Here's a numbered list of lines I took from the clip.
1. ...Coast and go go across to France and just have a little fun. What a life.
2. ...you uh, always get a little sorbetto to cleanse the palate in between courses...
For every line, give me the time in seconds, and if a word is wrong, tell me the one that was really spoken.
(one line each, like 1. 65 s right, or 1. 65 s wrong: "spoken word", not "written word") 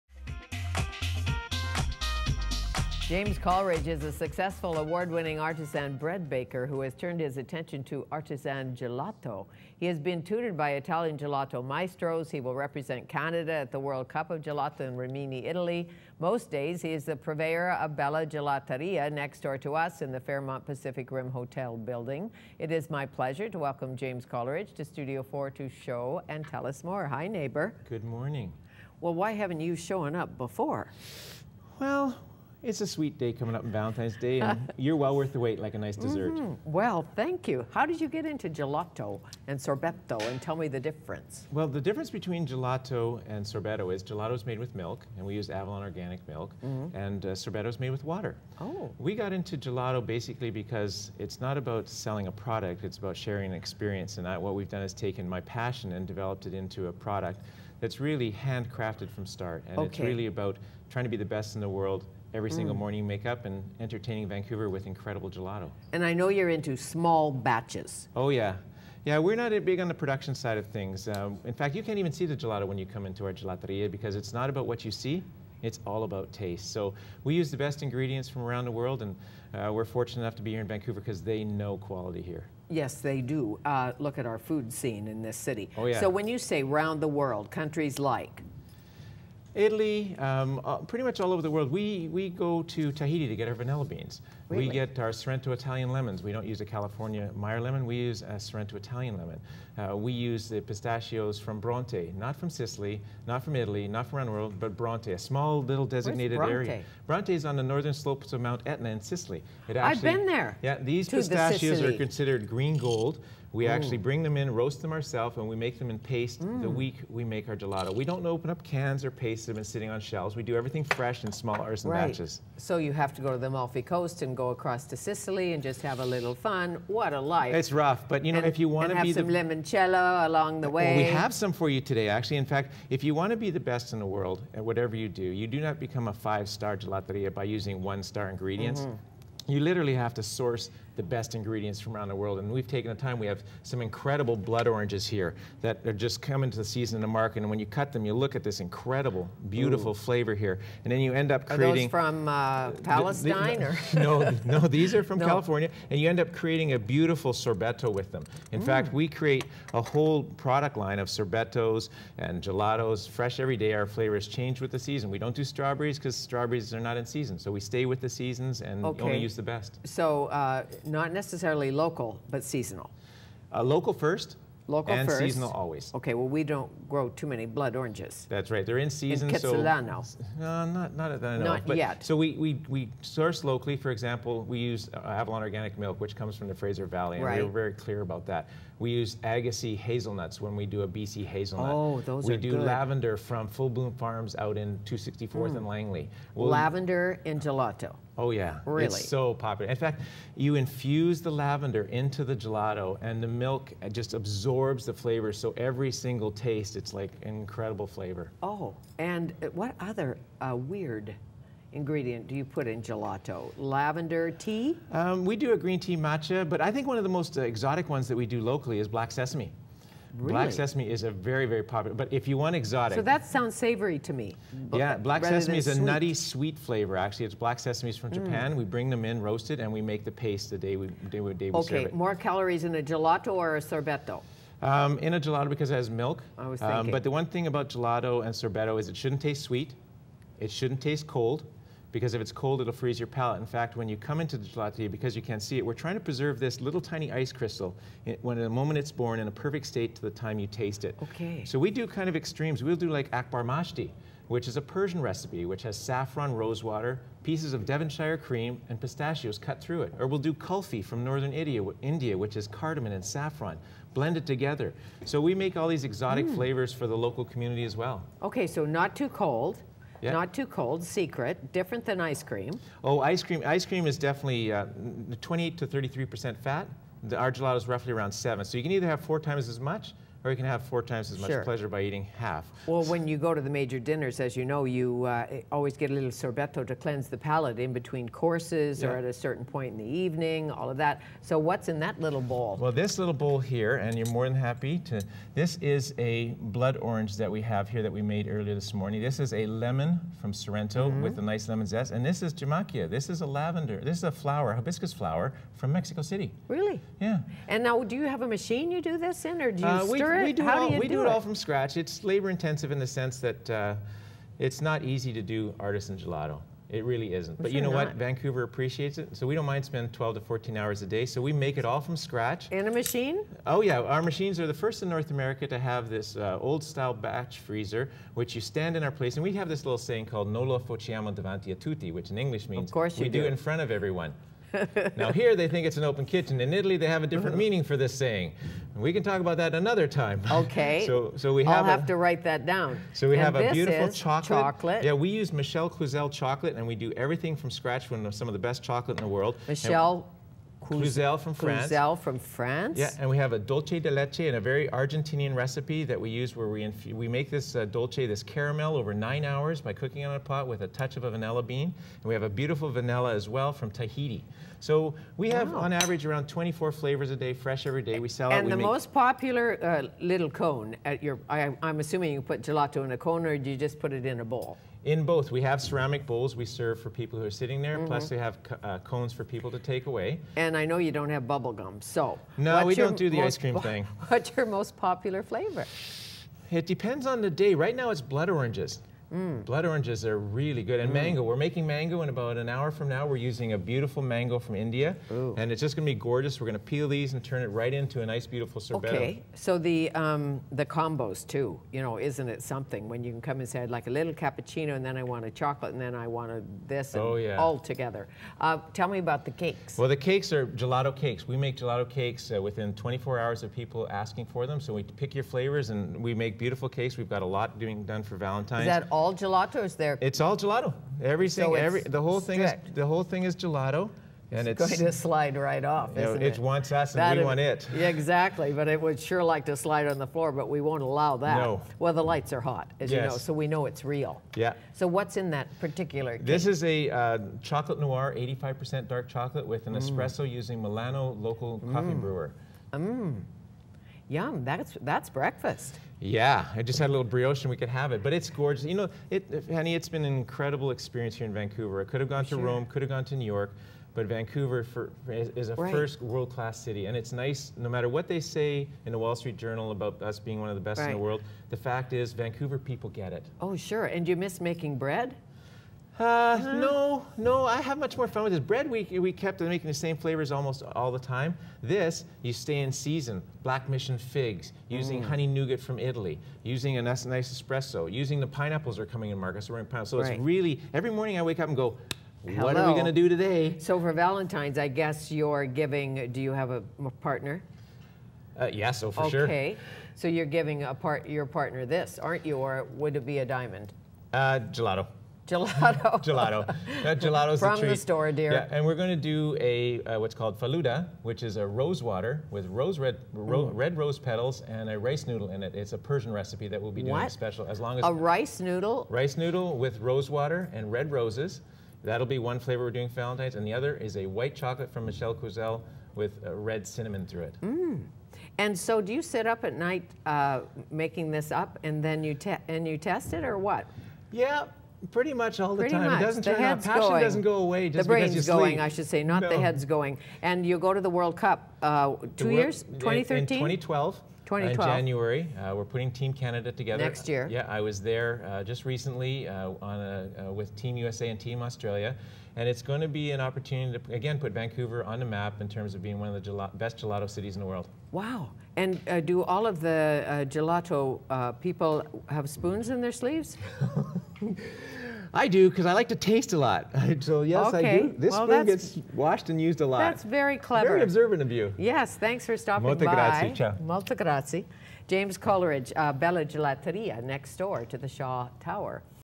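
1. 123 s wrong: "Sicily", not "France"
2. 284 s right.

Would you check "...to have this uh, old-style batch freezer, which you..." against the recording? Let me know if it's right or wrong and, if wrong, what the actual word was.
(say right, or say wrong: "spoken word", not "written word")
right.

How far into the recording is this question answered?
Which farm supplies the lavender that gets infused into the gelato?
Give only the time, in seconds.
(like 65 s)
193 s.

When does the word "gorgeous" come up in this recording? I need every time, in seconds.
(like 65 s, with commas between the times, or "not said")
395 s, 448 s.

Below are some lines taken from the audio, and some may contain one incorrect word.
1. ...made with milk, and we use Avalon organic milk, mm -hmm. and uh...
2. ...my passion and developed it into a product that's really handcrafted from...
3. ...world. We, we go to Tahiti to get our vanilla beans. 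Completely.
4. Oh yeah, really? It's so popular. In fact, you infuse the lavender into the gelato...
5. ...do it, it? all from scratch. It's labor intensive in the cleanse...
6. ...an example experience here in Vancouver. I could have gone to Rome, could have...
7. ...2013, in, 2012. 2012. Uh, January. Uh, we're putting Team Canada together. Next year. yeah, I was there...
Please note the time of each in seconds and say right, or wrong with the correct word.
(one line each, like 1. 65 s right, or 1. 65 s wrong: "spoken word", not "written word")
1. 44 s right
2. 55 s right
3. 91 s right
4. 198 s right
5. 310 s wrong: "sense", not "cleanse"
6. 450 s wrong: "incredible", not "example"
7. 532 s right.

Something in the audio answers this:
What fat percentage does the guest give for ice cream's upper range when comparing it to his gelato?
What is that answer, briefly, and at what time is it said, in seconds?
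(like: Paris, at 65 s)
33%, at 275 s.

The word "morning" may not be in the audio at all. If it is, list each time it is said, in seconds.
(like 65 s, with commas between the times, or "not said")
28 s, 62 s, 298 s, 480 s.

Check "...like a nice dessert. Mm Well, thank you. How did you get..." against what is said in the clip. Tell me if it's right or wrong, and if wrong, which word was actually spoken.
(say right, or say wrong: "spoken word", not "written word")
right.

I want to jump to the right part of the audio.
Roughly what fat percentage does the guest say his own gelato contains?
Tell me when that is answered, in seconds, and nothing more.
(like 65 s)
277 s.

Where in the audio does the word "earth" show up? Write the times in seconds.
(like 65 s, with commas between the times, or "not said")
not said.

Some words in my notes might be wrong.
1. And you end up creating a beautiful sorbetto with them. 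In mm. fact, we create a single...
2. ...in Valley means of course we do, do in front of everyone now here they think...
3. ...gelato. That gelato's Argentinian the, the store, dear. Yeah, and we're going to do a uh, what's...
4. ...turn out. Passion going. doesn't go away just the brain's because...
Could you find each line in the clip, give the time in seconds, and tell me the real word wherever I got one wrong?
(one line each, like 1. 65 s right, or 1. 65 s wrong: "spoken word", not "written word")
1. 155 s wrong: "whole", not "single"
2. 332 s wrong: "English", not "Valley"
3. 496 s wrong: "From", not "Argentinian"
4. 526 s right.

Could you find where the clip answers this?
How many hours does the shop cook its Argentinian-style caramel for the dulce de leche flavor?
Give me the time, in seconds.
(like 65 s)
358 s.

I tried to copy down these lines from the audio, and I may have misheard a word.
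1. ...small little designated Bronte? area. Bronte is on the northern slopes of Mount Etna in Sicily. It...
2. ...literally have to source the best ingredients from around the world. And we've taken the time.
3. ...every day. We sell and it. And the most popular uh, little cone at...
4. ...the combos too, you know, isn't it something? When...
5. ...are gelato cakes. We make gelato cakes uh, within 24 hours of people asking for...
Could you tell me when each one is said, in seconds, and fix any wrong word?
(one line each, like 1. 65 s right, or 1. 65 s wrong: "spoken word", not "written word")
1. 105 s right
2. 139 s right
3. 367 s right
4. 400 s right
5. 410 s right.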